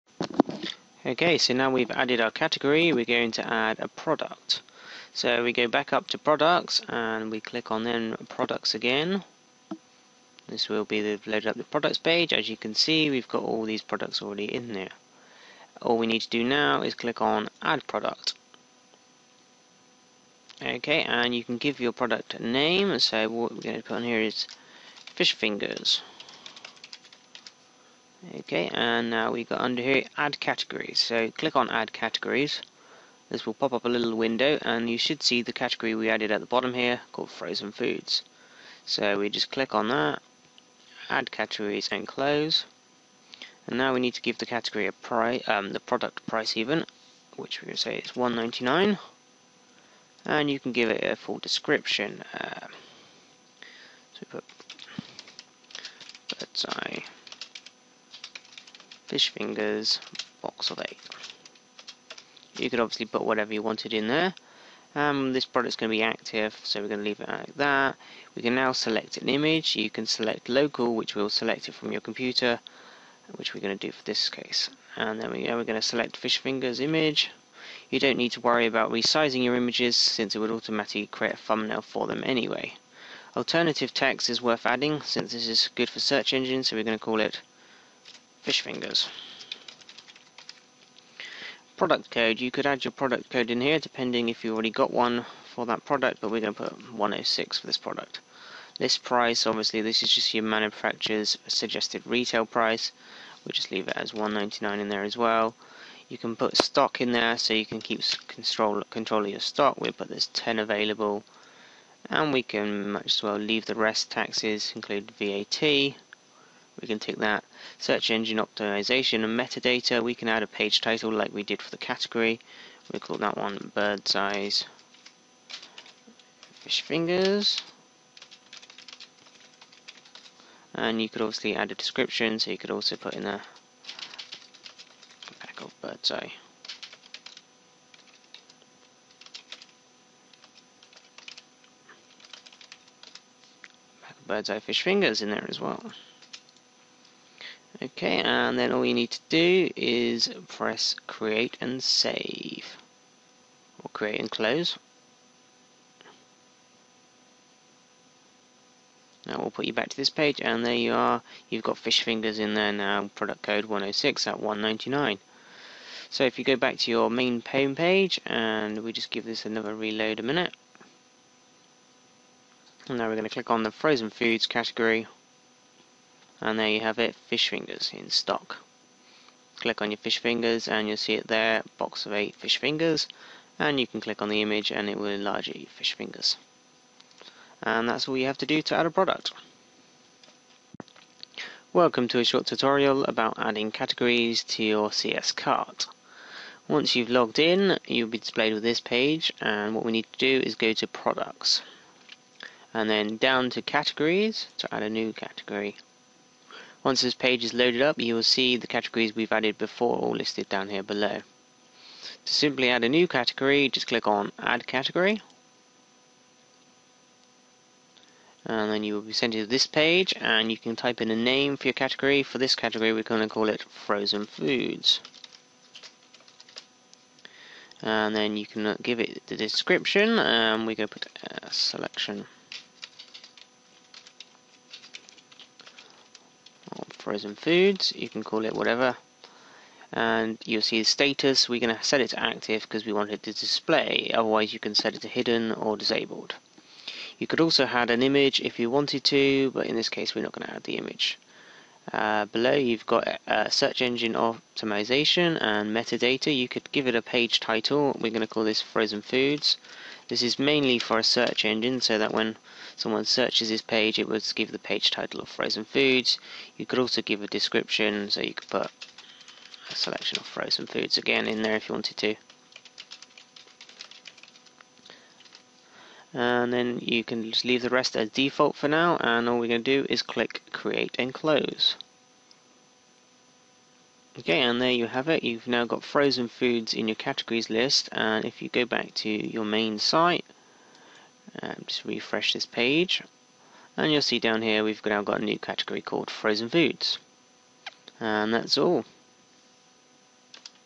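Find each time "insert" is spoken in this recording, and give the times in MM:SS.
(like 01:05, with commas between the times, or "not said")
not said.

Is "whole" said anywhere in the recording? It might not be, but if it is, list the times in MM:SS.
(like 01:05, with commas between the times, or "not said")
not said.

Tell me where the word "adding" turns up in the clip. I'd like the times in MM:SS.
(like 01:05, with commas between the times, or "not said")
01:24, 03:13.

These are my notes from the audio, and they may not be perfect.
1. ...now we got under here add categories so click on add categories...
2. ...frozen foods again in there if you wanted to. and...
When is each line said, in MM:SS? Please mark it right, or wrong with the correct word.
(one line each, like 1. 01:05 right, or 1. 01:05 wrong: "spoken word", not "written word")
1. 00:29 right
2. 04:30 right.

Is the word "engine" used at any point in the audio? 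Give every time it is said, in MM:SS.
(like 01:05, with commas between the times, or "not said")
01:26, 01:58, 04:13, 04:21.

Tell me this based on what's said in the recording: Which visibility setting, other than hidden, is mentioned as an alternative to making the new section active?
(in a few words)
Disabled.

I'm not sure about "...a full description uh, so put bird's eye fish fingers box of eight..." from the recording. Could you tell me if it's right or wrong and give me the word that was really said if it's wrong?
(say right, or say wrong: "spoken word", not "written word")
right.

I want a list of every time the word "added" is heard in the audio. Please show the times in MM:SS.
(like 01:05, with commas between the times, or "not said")
00:01, 00:36, 03:29.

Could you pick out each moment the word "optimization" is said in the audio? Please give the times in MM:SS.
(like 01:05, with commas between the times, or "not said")
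01:58, 04:14.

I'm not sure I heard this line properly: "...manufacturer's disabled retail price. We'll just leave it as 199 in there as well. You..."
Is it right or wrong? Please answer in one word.
wrong.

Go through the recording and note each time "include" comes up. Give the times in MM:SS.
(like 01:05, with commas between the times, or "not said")
01:54.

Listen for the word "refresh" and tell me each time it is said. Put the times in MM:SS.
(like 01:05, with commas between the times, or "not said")
04:51.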